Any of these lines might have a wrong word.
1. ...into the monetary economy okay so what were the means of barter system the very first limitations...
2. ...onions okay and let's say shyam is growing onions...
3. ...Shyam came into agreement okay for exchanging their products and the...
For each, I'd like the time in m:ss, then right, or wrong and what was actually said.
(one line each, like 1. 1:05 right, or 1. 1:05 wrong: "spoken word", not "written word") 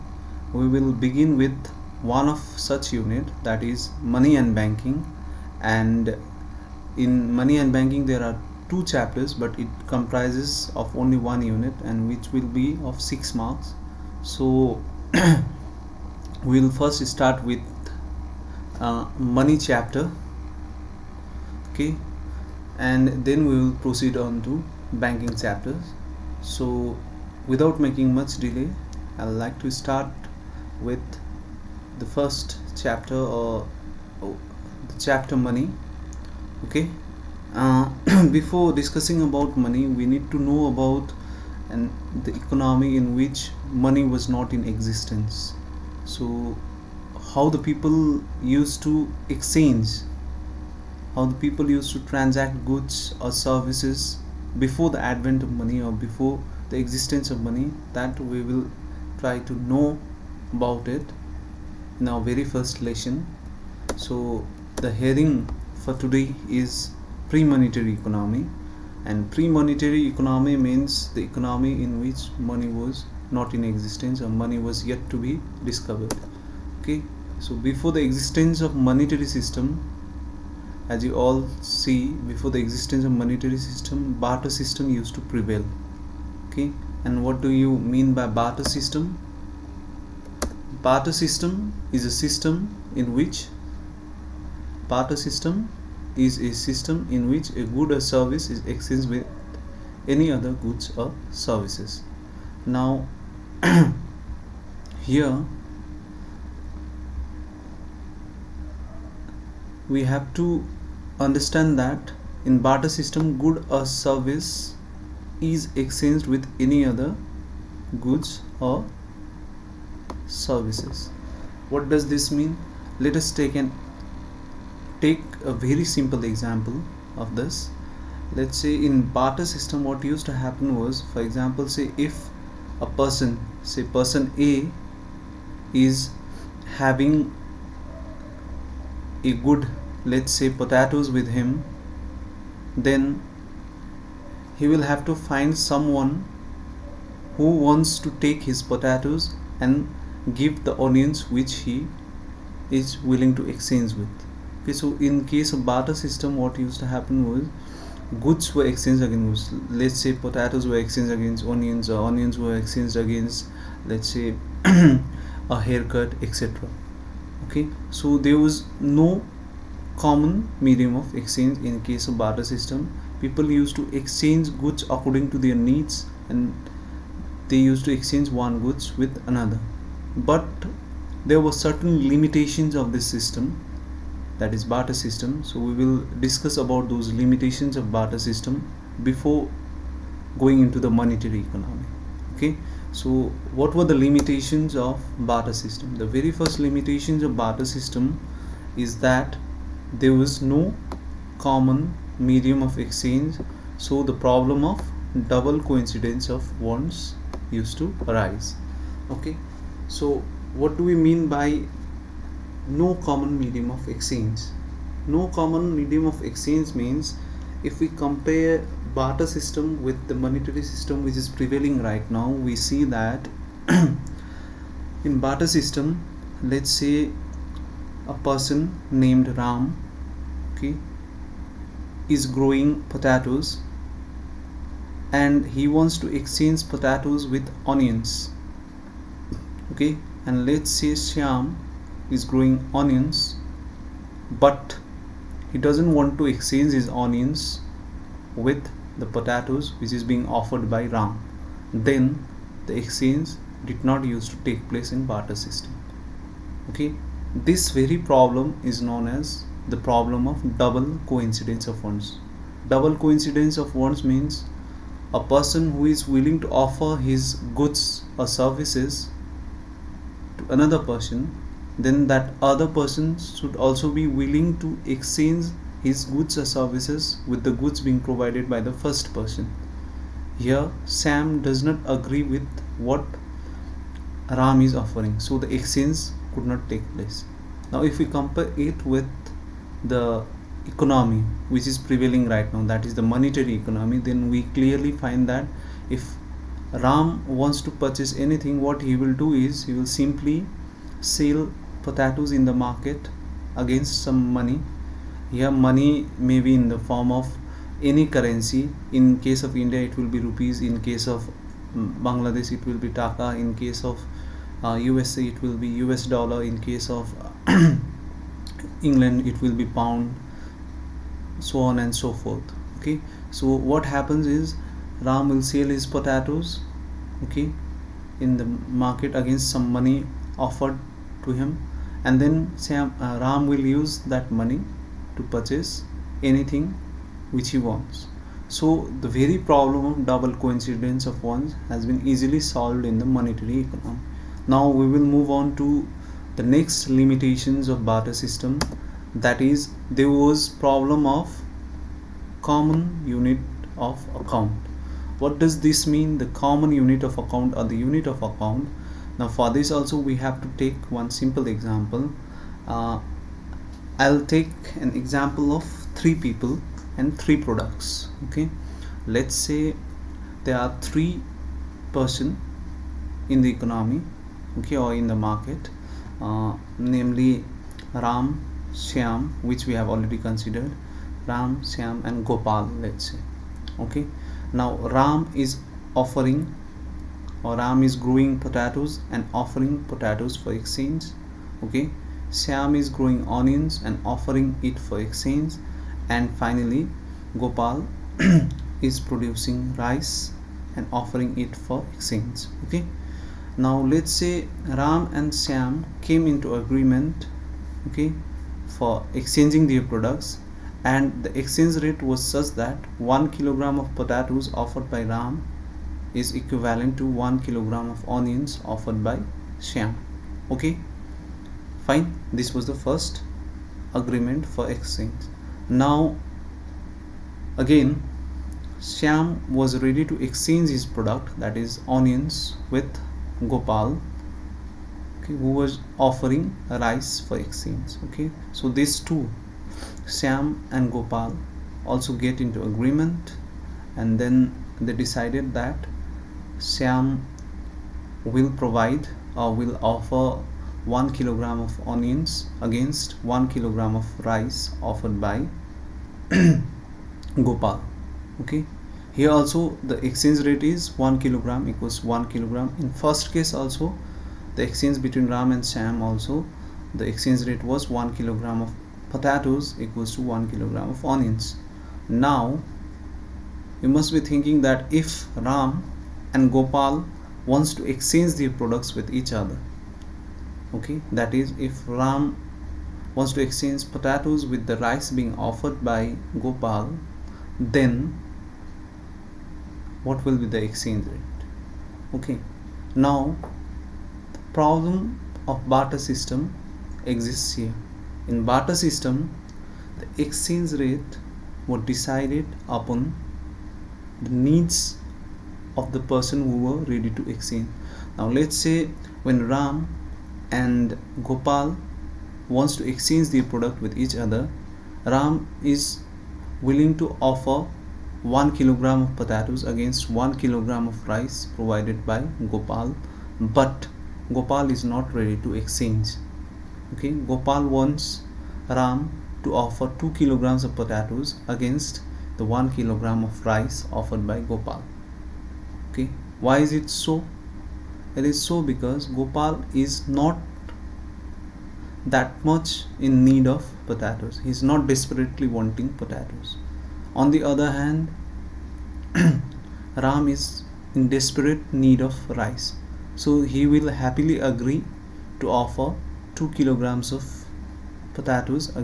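1. 3:10 wrong: "limitations", not "means"
2. 3:57 right
3. 6:45 right.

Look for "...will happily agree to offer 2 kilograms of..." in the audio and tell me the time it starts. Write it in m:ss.
9:13.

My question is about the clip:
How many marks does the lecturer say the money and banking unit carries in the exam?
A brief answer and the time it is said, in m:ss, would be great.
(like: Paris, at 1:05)
6, at 0:13.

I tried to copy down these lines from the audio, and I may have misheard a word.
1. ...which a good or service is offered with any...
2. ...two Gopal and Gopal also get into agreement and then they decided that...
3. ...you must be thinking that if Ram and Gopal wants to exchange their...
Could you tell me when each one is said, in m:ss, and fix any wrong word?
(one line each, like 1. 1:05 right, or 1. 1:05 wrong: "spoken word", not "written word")
1. 1:37 wrong: "exchanged", not "offered"
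2. 7:18 wrong: "Sam", not "Gopal"
3. 7:53 right.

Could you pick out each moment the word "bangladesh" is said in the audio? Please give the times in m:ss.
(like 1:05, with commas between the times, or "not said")
5:12.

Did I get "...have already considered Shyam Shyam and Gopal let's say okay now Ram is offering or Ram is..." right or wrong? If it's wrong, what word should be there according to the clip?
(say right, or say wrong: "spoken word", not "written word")
wrong: "Ram", not "Shyam".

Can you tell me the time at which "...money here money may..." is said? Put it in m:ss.
5:04.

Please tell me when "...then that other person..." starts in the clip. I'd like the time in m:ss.
4:31.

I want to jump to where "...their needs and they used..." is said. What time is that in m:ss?
2:55.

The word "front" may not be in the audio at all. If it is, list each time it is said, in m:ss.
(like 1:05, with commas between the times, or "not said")
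not said.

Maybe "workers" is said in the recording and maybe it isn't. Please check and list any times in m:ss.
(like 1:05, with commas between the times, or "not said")
not said.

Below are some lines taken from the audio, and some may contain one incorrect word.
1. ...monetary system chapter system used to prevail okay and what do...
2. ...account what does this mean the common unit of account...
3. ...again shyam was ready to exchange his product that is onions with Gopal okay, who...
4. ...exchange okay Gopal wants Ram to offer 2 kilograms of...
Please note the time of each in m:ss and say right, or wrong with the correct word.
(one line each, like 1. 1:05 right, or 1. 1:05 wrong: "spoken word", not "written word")
1. 1:23 wrong: "barter", not "chapter"
2. 5:54 right
3. 7:07 right
4. 8:45 right.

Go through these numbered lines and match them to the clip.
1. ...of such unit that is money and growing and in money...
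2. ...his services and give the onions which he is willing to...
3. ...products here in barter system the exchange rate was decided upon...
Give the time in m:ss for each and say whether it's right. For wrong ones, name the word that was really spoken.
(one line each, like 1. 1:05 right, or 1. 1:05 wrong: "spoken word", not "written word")
1. 0:02 wrong: "banking", not "growing"
2. 2:28 wrong: "potatoes", not "services"
3. 8:17 wrong: "exists", not "products".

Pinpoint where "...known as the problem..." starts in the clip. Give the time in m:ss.
4:18.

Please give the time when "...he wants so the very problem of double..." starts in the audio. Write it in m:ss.
5:37.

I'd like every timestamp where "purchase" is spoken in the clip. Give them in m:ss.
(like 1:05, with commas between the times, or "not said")
4:57, 5:35.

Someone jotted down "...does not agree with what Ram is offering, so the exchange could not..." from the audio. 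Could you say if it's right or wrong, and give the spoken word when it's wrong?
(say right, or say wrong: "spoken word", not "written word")
right.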